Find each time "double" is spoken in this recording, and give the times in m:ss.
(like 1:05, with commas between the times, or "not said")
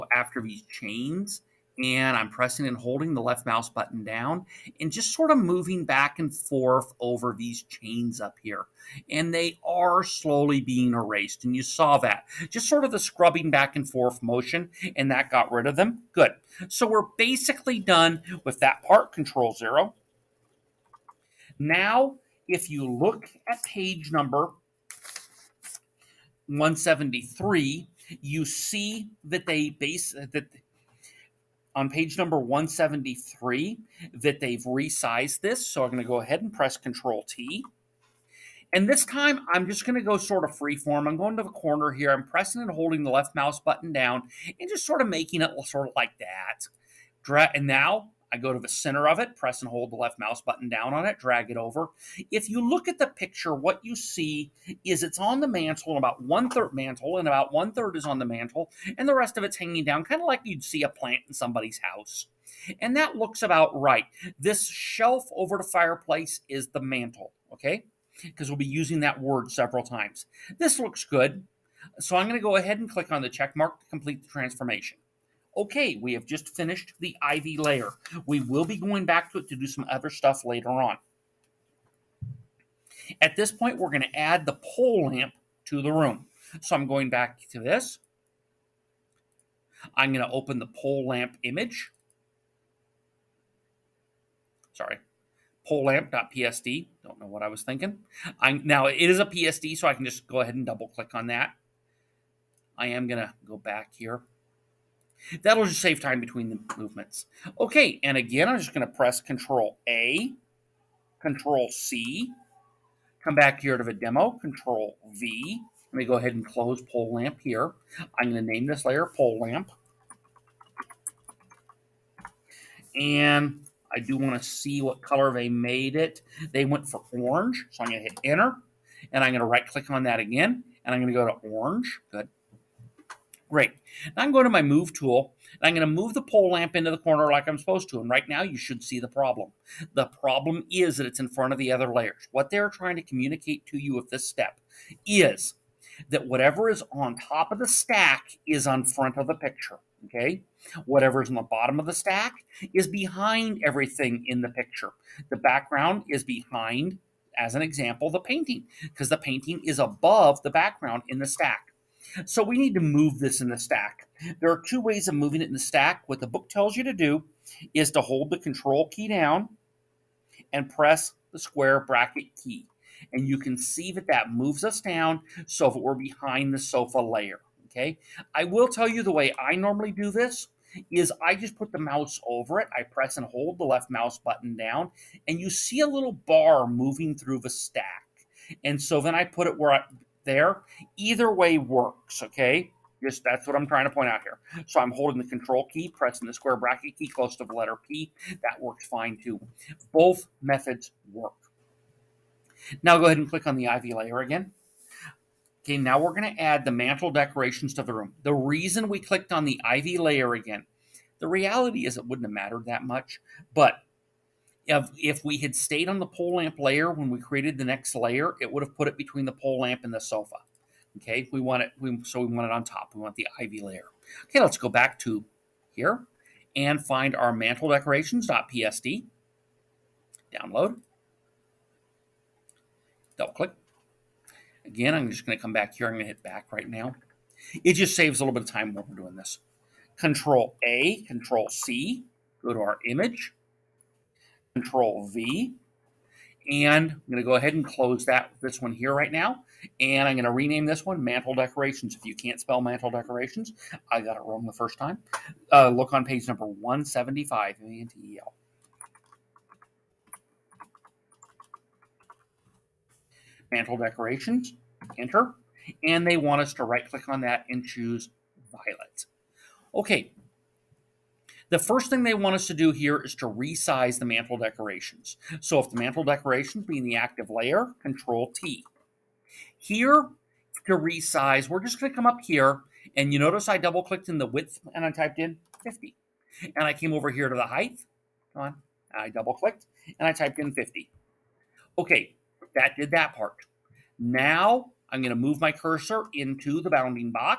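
1:40, 3:53, 4:43, 4:49.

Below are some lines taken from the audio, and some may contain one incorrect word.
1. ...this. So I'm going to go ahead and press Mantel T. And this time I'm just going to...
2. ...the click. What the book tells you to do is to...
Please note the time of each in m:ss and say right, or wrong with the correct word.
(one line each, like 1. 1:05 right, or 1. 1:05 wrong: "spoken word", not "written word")
1. 0:35 wrong: "Control", not "Mantel"
2. 2:45 wrong: "stack", not "click".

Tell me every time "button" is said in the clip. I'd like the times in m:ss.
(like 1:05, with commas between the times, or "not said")
0:03, 0:43, 0:50, 3:04.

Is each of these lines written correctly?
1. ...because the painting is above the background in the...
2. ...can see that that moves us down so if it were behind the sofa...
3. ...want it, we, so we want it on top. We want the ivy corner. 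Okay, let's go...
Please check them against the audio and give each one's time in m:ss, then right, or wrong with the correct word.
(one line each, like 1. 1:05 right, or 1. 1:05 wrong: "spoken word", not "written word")
1. 2:38 right
2. 2:53 right
3. 3:41 wrong: "layer", not "corner".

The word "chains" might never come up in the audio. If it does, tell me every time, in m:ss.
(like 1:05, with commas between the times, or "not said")
0:00, 0:07.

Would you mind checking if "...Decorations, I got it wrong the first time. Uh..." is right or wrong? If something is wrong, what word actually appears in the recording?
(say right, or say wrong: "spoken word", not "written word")
right.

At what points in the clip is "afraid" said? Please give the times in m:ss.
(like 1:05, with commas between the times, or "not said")
not said.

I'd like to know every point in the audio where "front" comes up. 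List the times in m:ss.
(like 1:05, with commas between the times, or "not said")
2:21, 2:28.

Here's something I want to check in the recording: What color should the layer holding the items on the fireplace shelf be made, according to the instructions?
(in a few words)
Violet.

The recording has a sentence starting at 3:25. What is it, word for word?
Okay, now we're going to add the mantel decorations to the room.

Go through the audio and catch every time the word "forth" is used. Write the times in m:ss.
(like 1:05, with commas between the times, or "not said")
0:06, 0:13.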